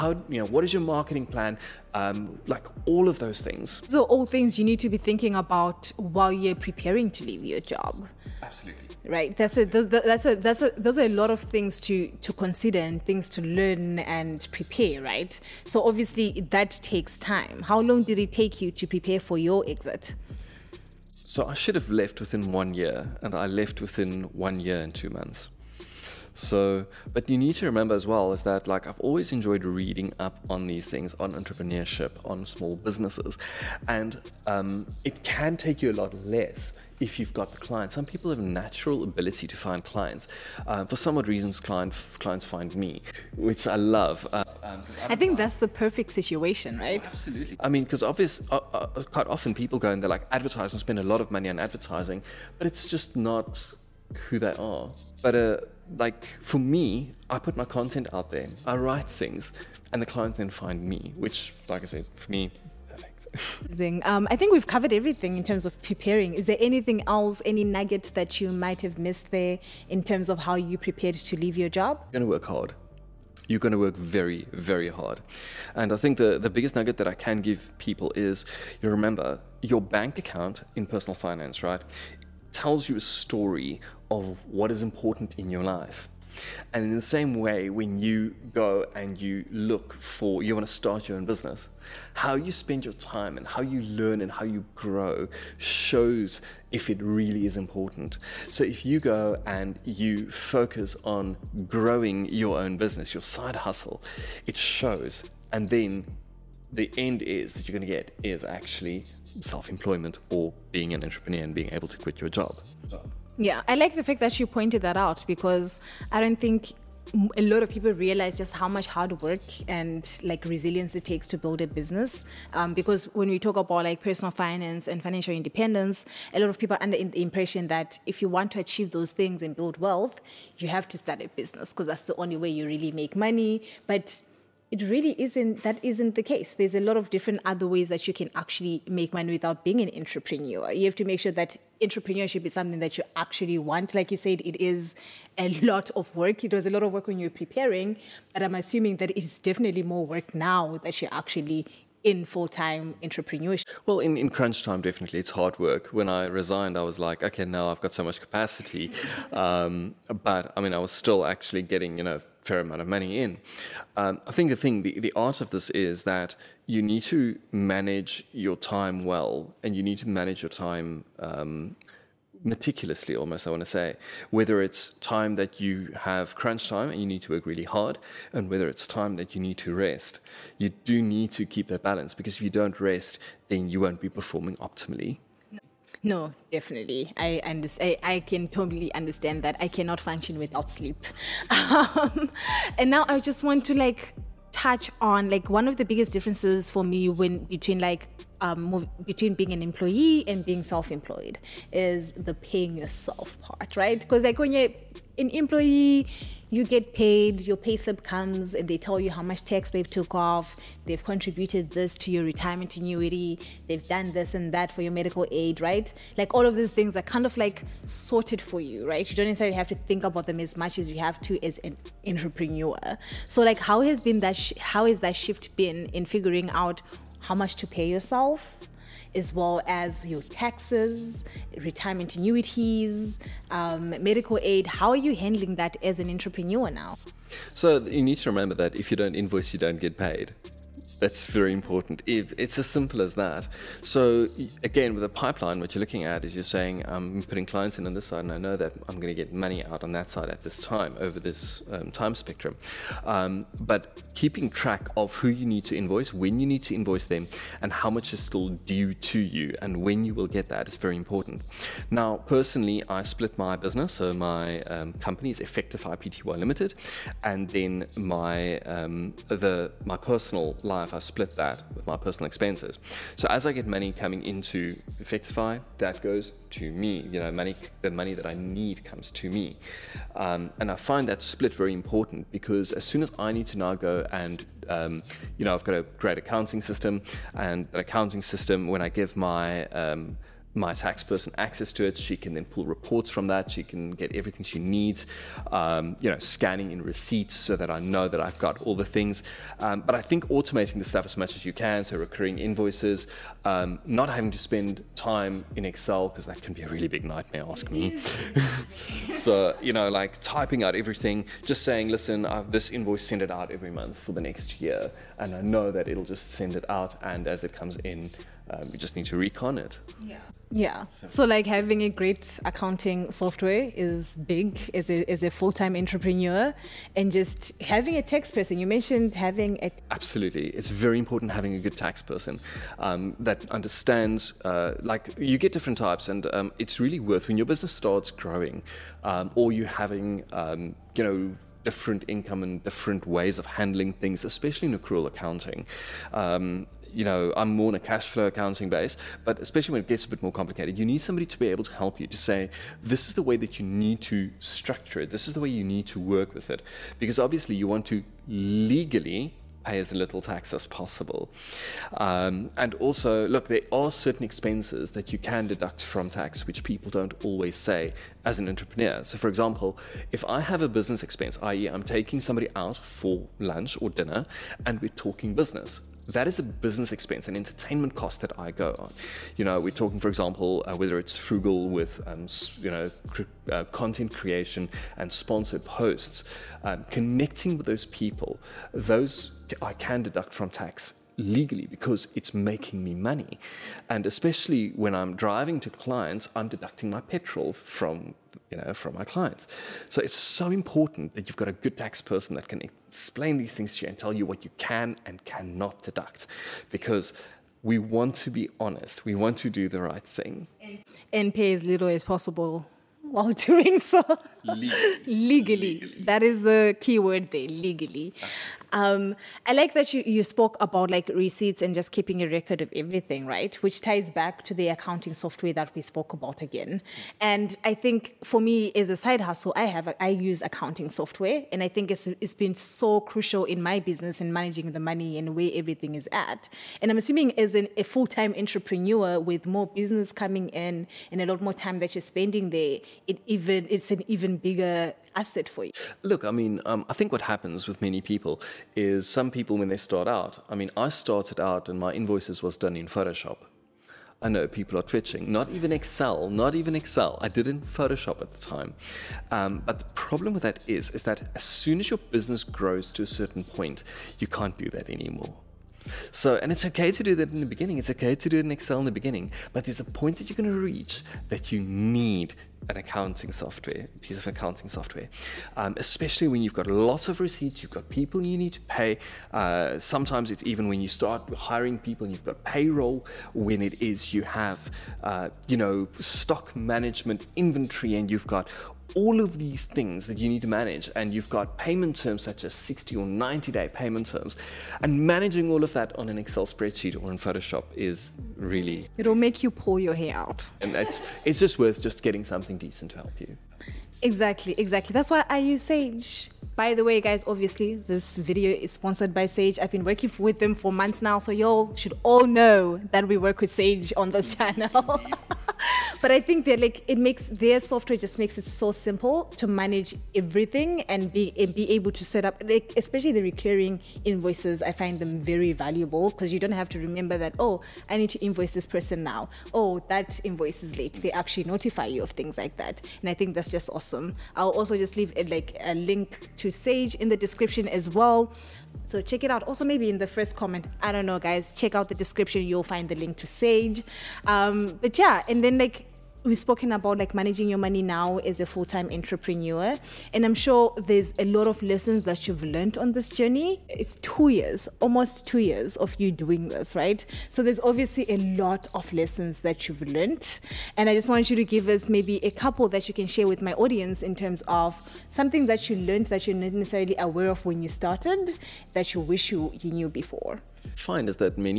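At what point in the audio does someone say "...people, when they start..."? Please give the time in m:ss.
7:29.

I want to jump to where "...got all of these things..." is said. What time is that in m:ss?
8:08.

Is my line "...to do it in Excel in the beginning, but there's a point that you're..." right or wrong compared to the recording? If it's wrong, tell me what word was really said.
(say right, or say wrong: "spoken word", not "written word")
right.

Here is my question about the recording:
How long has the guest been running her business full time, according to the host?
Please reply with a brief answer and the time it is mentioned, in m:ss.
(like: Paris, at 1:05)
Almost 2 years, at 9:14.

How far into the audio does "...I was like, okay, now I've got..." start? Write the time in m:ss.
2:36.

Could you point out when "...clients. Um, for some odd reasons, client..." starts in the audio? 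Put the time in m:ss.
0:39.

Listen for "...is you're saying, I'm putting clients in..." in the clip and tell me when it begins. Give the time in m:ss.
4:06.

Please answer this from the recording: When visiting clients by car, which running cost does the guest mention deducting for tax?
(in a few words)
Petrol.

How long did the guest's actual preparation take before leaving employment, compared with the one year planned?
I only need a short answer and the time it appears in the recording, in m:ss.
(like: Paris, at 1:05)
1 year and 2 months, at 0:24.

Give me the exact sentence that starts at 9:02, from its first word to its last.
You'll find the link to Sage.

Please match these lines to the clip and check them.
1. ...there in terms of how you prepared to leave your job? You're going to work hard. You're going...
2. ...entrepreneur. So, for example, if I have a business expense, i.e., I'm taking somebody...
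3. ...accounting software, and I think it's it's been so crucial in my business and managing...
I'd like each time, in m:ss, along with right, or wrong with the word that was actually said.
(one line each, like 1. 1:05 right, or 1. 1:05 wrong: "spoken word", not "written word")
1. 1:09 right
2. 6:08 right
3. 7:10 right.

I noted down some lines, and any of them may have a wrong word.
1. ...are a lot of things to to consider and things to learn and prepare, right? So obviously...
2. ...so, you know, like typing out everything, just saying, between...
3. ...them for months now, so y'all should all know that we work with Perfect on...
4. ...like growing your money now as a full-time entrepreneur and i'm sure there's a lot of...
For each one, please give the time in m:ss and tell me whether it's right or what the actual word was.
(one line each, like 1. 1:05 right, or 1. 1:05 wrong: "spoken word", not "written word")
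1. 0:10 right
2. 5:09 wrong: "listen", not "between"
3. 8:30 wrong: "Sage", not "Perfect"
4. 9:06 wrong: "managing", not "growing".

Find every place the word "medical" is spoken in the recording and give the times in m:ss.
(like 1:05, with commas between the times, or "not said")
3:34, 3:54.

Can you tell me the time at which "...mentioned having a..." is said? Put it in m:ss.
5:28.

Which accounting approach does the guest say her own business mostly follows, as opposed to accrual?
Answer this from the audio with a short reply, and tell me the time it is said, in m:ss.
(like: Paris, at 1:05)
Cash flow accounting, at 5:47.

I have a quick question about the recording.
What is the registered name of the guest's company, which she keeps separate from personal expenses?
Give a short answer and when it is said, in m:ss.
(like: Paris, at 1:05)
Effectify Pty Limited, at 4:25.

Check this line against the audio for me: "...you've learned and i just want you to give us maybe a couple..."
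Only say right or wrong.
right.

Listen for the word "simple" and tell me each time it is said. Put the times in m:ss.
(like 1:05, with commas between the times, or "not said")
4:02, 8:38.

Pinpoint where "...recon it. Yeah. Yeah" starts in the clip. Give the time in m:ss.
5:19.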